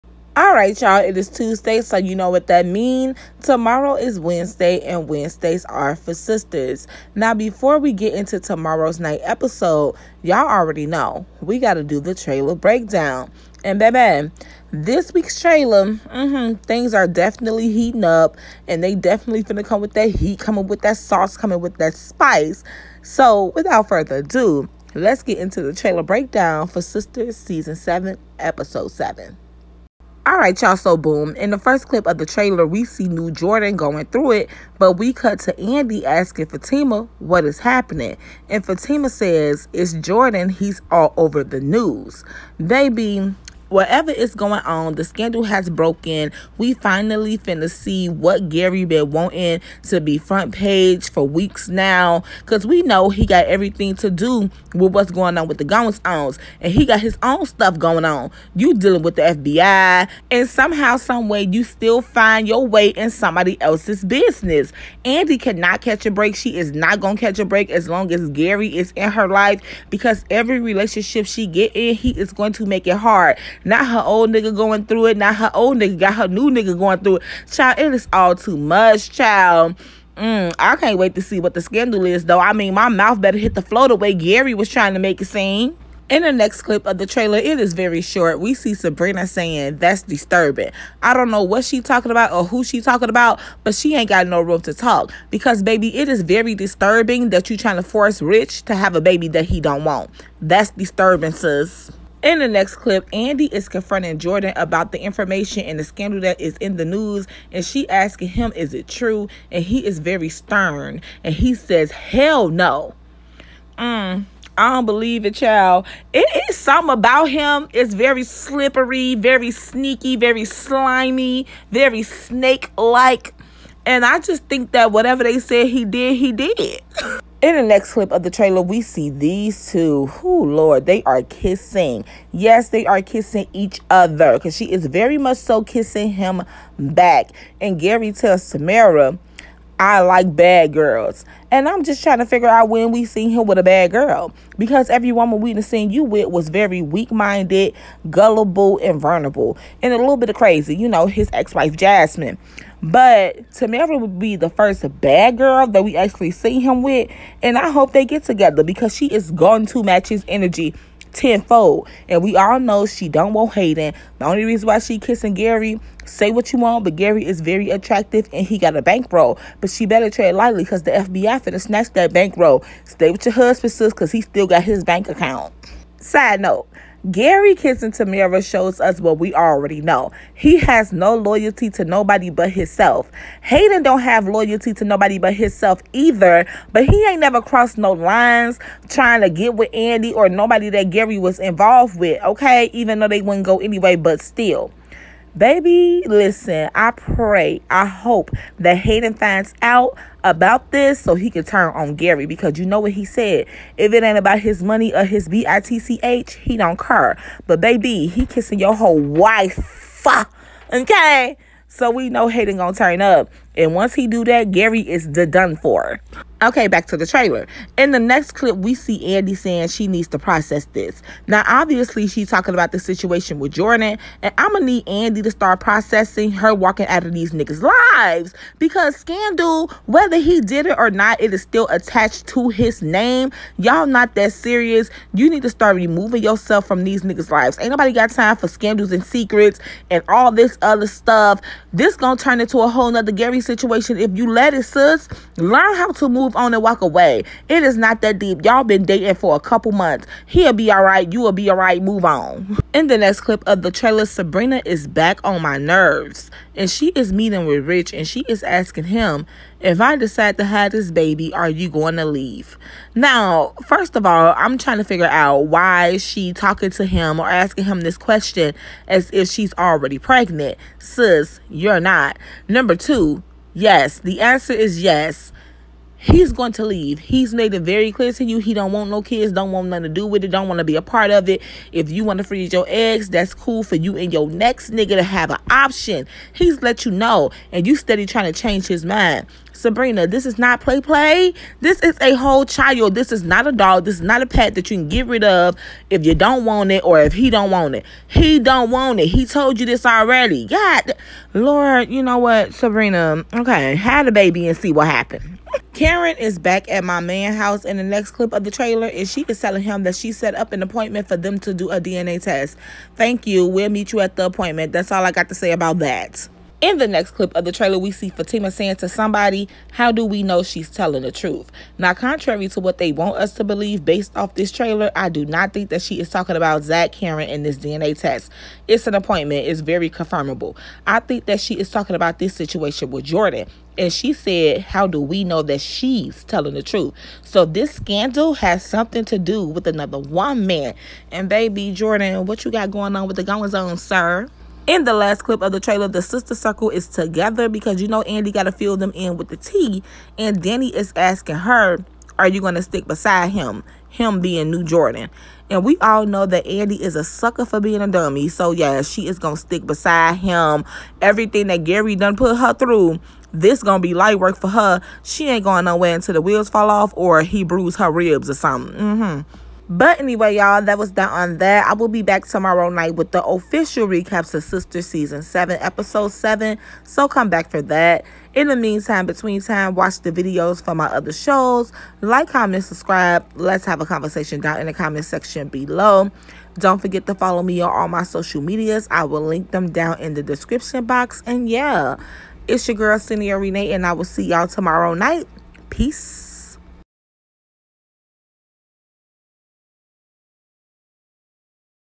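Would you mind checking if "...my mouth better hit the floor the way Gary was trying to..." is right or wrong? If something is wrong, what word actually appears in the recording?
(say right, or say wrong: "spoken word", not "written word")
right.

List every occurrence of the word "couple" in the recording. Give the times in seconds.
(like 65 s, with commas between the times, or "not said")
249 s.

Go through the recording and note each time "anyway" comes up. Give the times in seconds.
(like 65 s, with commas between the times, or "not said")
193 s, 370 s.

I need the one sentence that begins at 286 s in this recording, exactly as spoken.
He's let you know, and you steady trying to change his mind.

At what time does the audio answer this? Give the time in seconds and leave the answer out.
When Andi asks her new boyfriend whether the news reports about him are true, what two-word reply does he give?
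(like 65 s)
111 s.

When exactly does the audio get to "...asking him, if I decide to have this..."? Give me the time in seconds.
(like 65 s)
258 s.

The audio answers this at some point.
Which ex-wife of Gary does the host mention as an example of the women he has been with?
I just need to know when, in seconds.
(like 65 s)
151 s.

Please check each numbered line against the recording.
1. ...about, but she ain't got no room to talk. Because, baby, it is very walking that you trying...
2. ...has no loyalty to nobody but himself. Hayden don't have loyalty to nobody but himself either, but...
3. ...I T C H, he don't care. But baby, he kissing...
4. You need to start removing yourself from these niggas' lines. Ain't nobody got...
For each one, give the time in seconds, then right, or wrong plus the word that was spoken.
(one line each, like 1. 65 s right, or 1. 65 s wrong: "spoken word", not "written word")
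1. 93 s wrong: "disturbing", not "walking"
2. 180 s right
3. 205 s right
4. 235 s wrong: "lives", not "lines".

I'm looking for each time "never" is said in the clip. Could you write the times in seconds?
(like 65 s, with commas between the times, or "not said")
187 s.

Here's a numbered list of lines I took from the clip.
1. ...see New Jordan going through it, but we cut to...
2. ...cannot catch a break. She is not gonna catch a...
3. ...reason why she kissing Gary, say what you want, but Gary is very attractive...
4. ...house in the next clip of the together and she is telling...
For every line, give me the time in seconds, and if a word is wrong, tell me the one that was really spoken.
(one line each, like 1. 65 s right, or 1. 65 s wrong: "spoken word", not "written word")
1. 32 s right
2. 65 s right
3. 164 s right
4. 307 s wrong: "trailer", not "together".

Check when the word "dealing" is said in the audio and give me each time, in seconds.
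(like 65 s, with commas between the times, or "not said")
58 s.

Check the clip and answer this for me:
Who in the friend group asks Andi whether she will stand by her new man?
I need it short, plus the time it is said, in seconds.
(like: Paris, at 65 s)
Danni, at 350 s.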